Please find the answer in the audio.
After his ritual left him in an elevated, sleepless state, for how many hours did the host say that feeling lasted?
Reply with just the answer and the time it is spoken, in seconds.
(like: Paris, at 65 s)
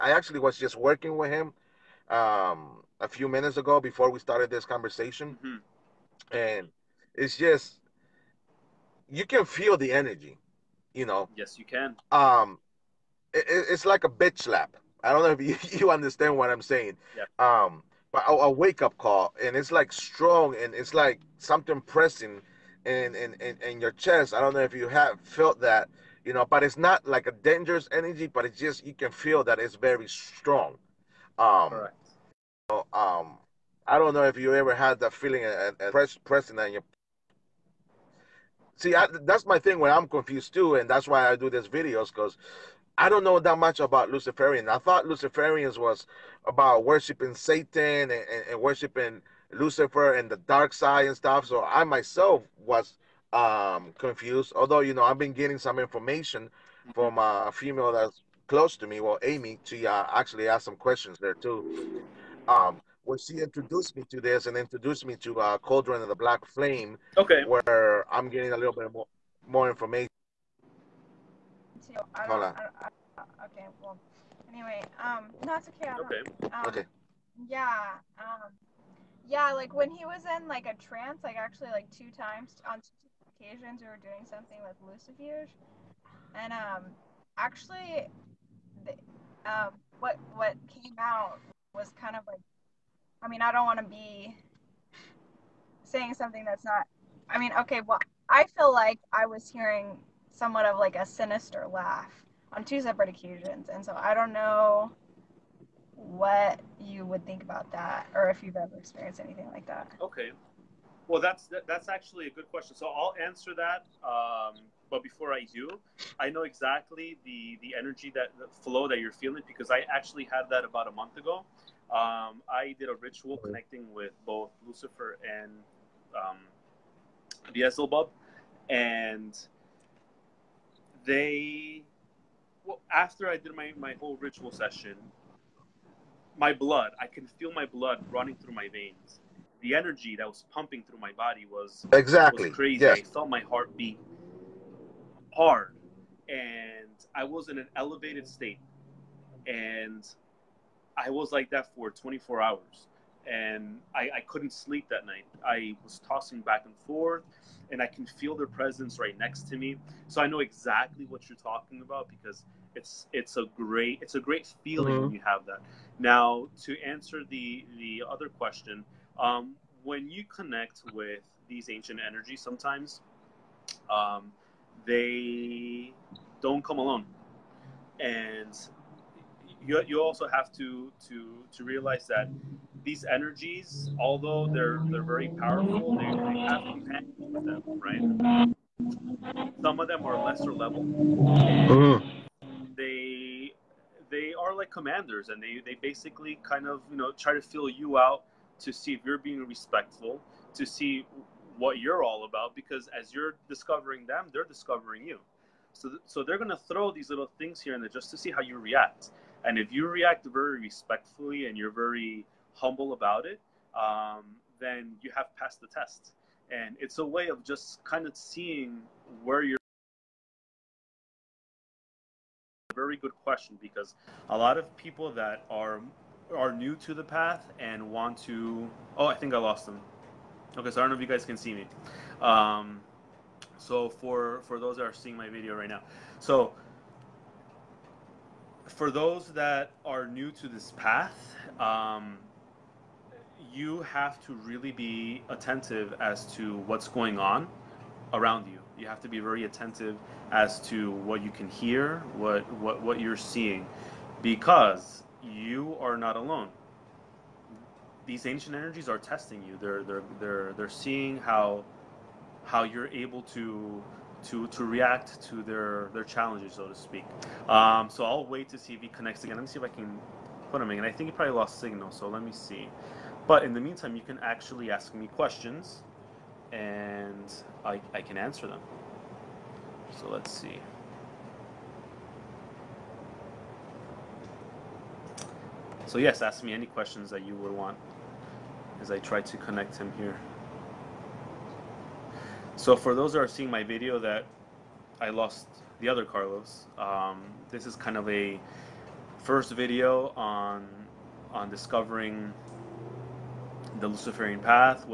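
24, at 151 s.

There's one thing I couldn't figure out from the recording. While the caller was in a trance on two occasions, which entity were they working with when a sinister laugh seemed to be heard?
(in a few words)
Lucifuge.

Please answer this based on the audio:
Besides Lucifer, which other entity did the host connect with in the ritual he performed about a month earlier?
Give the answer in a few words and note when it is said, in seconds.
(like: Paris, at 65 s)
Beelzebub, at 127 s.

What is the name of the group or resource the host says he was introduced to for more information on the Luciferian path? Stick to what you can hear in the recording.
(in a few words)
Cauldron of the Black Flame.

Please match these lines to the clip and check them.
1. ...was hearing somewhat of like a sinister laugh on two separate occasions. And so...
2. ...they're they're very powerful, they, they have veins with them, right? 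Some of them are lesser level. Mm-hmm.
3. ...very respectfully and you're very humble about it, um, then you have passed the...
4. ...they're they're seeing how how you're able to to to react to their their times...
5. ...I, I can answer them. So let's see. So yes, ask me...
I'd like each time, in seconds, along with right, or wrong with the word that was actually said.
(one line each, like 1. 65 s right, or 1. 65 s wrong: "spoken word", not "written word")
1. 99 s right
2. 184 s wrong: "companions", not "veins"
3. 210 s right
4. 260 s wrong: "challenges", not "times"
5. 277 s right.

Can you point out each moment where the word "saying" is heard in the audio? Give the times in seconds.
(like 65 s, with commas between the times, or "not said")
16 s, 95 s.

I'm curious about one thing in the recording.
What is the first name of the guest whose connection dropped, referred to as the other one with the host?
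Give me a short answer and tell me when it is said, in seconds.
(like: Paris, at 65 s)
Carlos, at 296 s.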